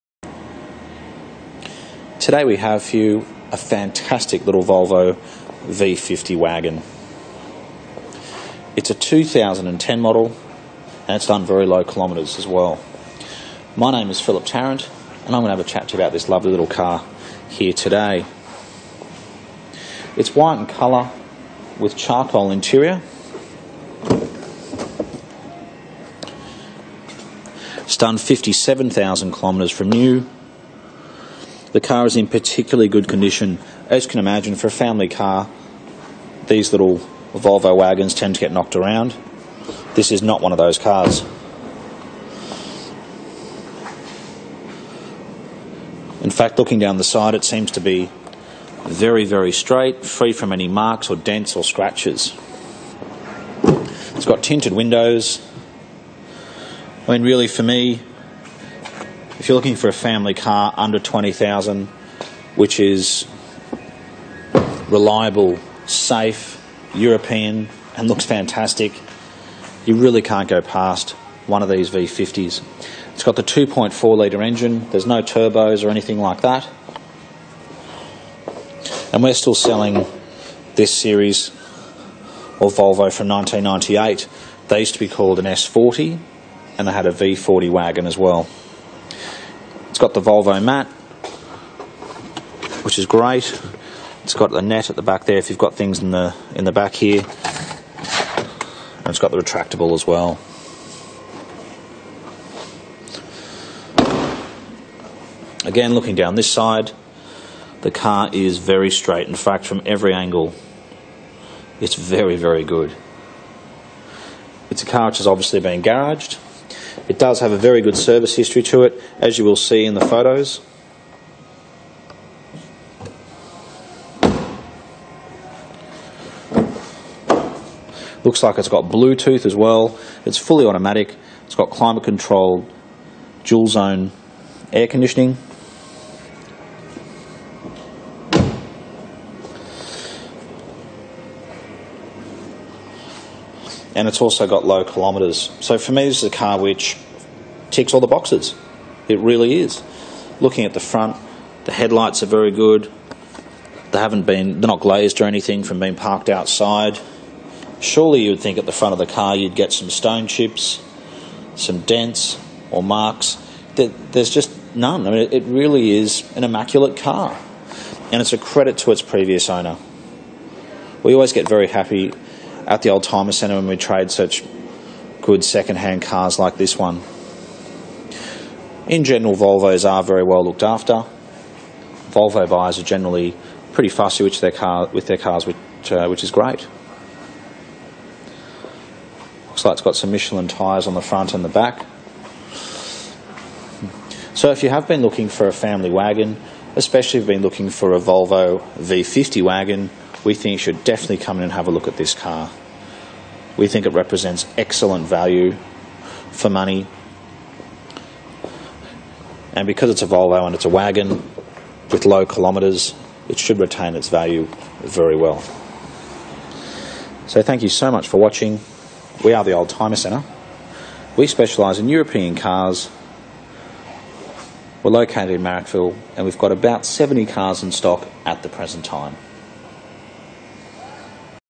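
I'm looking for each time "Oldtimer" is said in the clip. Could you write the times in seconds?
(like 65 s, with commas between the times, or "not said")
172 s, 219 s.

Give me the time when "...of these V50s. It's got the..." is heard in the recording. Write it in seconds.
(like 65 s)
71 s.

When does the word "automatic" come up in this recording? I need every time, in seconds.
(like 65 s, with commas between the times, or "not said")
130 s.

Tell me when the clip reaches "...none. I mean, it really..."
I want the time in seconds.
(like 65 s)
164 s.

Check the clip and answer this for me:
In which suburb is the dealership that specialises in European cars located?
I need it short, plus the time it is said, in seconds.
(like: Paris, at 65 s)
Marrickville, at 225 s.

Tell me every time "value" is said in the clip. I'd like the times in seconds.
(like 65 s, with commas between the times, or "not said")
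205 s, 214 s.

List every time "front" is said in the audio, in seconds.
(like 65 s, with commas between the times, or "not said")
150 s, 158 s, 191 s.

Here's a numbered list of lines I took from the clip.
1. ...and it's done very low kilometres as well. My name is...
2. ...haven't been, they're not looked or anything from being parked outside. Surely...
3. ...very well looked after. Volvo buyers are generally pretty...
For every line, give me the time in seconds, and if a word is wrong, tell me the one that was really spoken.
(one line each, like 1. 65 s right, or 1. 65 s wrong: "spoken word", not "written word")
1. 11 s right
2. 153 s wrong: "glazed", not "looked"
3. 180 s right.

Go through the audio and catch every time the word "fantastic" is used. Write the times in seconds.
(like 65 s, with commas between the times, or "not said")
3 s, 68 s.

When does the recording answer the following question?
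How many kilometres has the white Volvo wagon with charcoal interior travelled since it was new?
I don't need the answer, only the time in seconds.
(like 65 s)
28 s.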